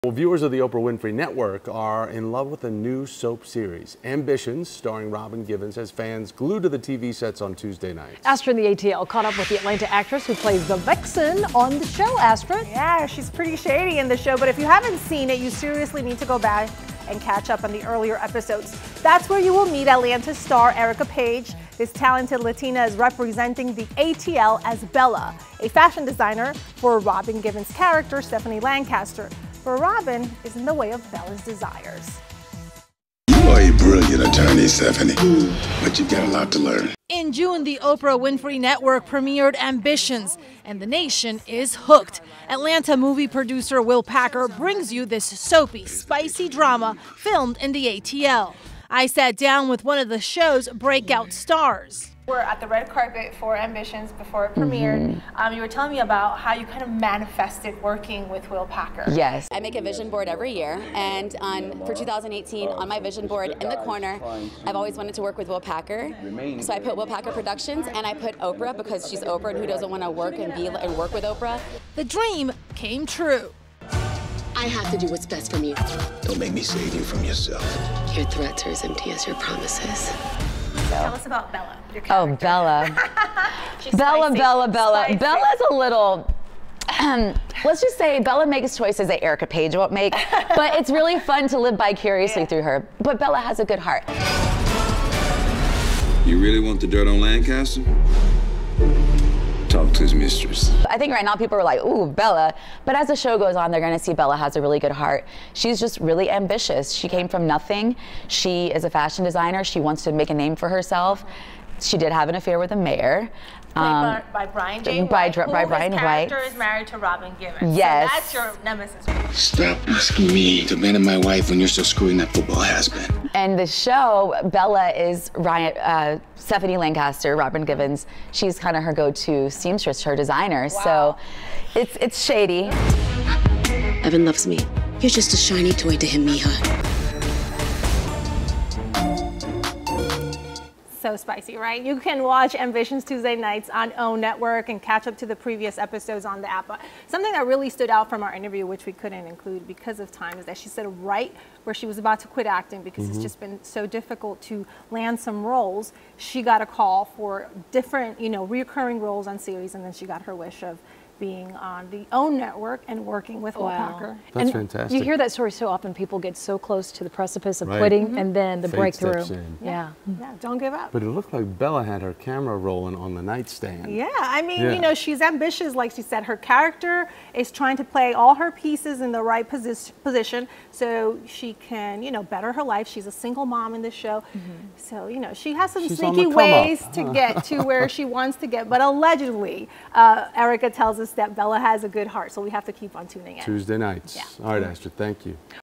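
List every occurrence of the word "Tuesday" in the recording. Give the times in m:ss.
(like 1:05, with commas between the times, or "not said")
0:07, 2:23, 3:13.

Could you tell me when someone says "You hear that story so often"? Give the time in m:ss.
2:44.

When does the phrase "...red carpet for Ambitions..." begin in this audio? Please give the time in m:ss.
0:52.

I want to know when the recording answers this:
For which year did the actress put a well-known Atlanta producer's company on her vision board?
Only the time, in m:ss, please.
1:01.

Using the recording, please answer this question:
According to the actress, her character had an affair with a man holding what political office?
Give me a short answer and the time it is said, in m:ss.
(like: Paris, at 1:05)
Mayor, at 1:52.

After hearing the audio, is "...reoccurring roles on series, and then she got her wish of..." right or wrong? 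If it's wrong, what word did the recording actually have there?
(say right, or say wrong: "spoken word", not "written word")
right.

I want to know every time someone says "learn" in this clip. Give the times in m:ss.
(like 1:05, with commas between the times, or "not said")
0:36.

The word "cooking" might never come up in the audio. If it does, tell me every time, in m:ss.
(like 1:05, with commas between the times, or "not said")
not said.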